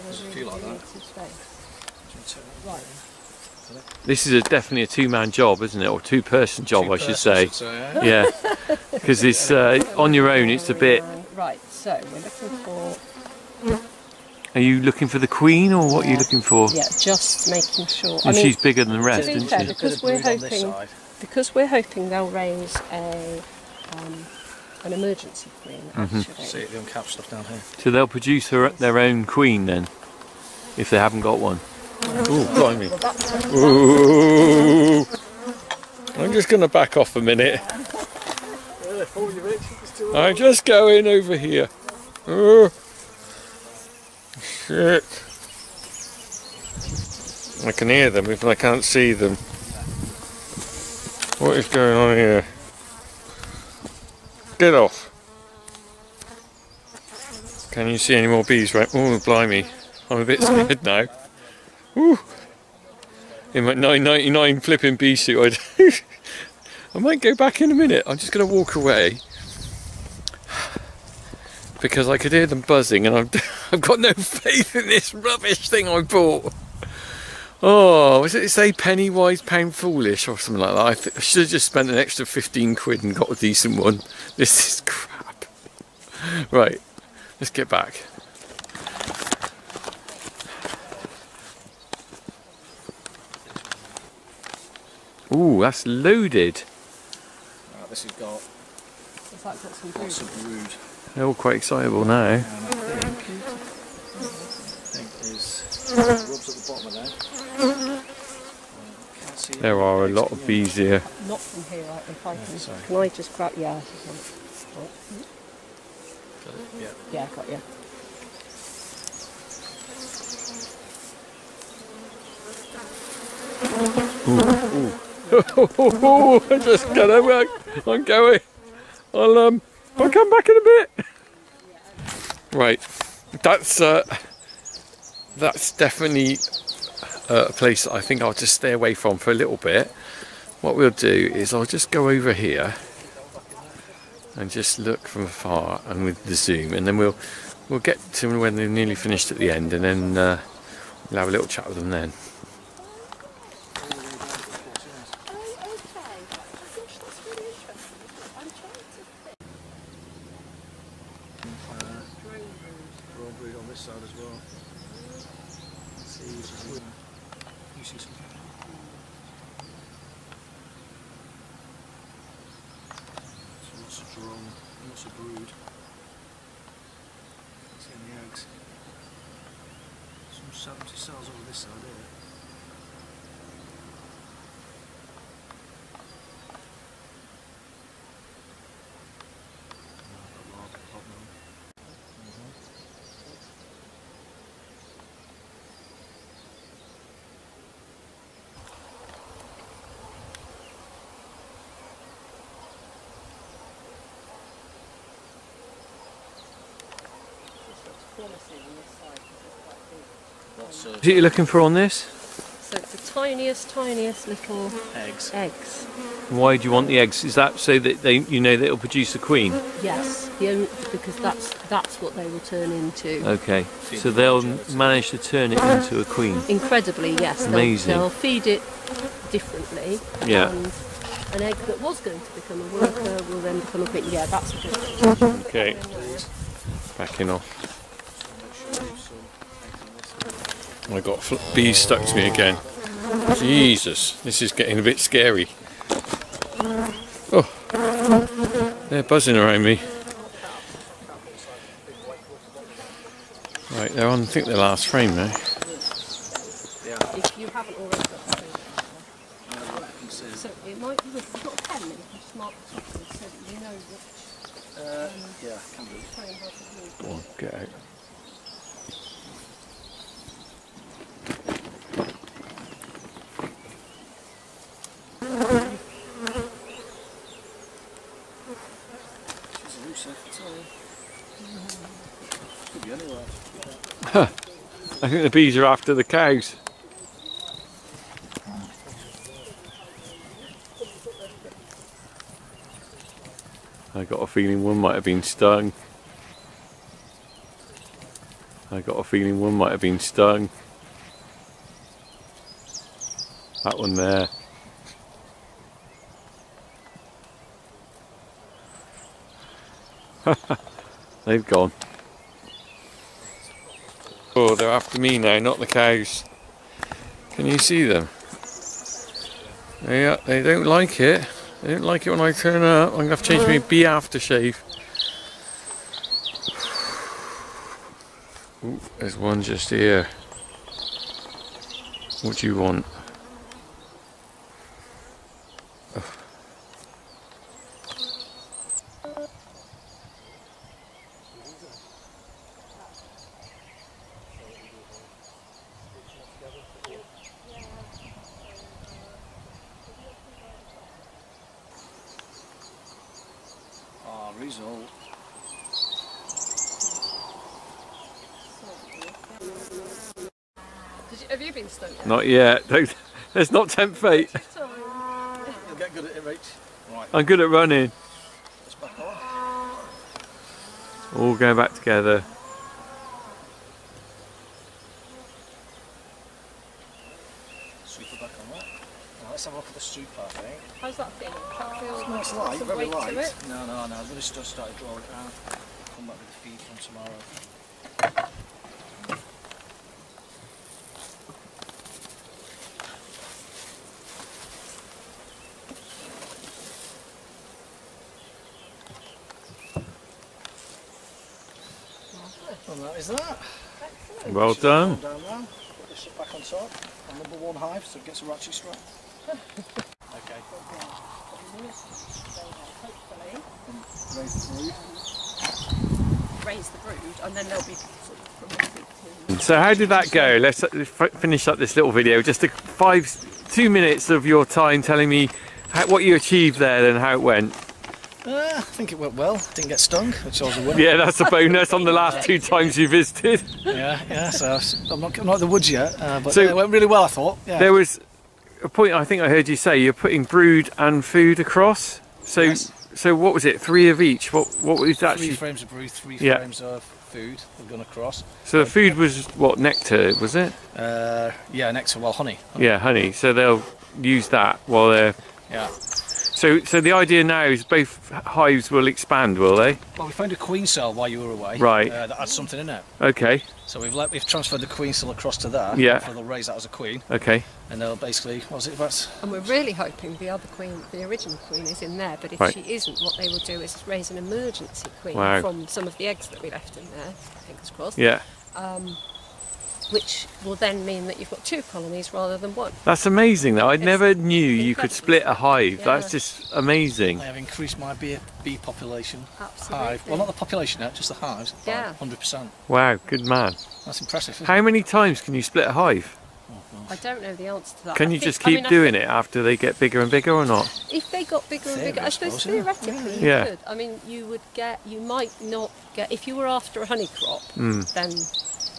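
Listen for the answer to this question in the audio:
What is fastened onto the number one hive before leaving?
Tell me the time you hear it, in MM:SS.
06:48.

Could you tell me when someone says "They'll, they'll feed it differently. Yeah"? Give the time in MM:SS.
03:47.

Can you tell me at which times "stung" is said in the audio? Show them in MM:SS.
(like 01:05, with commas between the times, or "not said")
04:55, 04:59, 07:09.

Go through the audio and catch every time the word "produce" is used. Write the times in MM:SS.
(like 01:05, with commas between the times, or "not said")
00:28, 03:38.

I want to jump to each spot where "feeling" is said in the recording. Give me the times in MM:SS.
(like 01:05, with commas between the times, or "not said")
04:54, 04:59, 06:21.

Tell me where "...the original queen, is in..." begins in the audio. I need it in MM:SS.
07:50.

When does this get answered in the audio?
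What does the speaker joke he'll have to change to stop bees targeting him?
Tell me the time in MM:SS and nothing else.
05:23.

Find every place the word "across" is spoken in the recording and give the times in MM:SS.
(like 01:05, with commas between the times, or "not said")
07:21, 07:27, 07:45.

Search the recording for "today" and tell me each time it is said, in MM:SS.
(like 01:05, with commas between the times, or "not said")
not said.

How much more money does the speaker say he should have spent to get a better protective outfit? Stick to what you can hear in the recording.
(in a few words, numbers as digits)
15 quid.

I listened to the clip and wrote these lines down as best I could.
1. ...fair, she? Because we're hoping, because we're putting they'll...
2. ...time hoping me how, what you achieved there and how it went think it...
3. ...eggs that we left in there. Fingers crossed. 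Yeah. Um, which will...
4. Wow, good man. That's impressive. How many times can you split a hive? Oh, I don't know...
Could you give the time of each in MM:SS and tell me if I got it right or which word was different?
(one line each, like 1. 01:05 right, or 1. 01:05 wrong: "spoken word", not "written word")
1. 00:19 wrong: "hoping", not "putting"
2. 07:04 wrong: "telling", not "hoping"
3. 07:56 right
4. 08:12 right.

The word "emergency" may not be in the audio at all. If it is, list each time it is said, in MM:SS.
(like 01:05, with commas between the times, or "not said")
00:24, 07:54.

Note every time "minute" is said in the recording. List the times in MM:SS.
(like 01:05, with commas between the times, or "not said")
00:37, 01:07, 07:03.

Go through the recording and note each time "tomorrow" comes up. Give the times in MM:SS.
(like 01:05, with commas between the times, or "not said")
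06:26.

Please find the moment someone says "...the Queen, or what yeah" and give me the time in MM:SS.
00:15.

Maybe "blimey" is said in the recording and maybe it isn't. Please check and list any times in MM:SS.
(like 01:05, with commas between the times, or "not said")
00:32, 00:59.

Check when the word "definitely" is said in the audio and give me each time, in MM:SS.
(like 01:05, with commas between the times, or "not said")
00:04, 02:15.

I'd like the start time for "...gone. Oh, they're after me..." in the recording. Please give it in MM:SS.
05:11.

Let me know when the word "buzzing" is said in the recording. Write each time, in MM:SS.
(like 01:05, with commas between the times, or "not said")
01:12, 04:09.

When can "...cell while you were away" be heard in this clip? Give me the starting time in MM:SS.
07:40.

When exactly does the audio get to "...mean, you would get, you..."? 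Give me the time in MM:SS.
08:23.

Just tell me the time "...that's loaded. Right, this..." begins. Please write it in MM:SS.
01:35.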